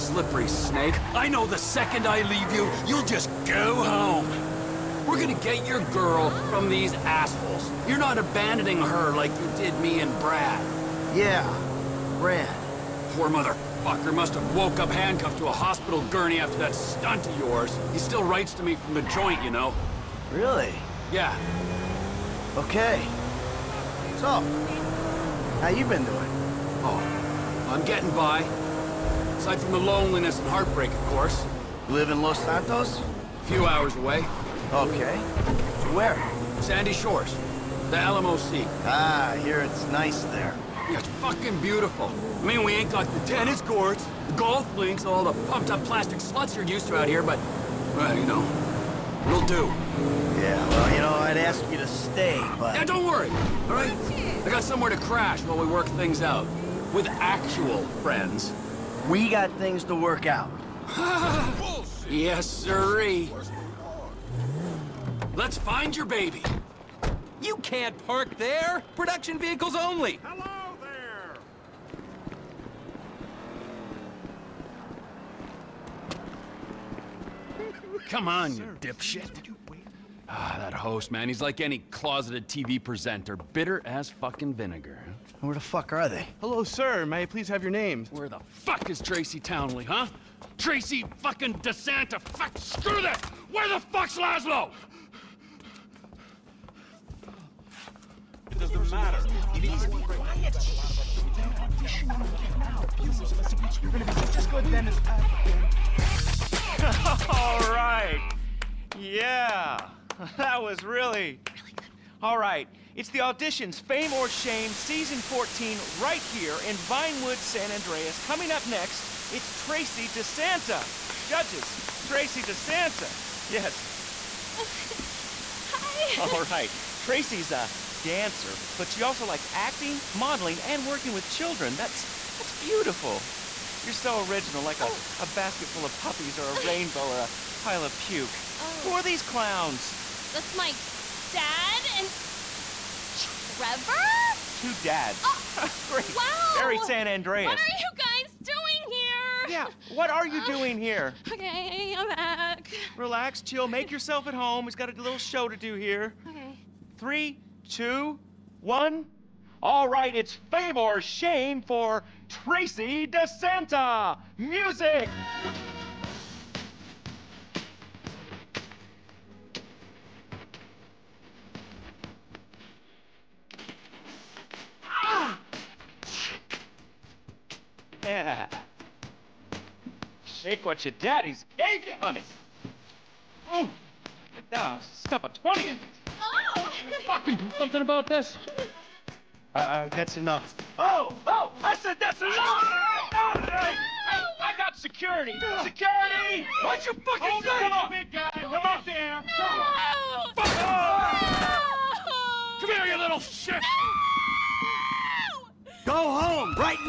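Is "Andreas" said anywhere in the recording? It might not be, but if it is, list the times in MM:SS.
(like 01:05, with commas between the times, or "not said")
01:57, 02:27.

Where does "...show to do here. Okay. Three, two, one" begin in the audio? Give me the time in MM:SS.
02:35.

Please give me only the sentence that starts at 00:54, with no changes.
I got somewhere to crash while we work things out.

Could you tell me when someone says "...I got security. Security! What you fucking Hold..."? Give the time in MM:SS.
03:14.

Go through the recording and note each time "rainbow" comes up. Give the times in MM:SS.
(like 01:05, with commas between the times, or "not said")
02:16.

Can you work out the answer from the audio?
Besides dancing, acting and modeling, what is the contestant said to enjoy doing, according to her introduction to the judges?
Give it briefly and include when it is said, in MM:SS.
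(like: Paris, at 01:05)
Working with children, at 02:10.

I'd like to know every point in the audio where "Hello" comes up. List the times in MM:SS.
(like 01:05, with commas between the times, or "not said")
01:10, 01:26.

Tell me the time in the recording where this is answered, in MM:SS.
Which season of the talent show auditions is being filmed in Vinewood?
01:54.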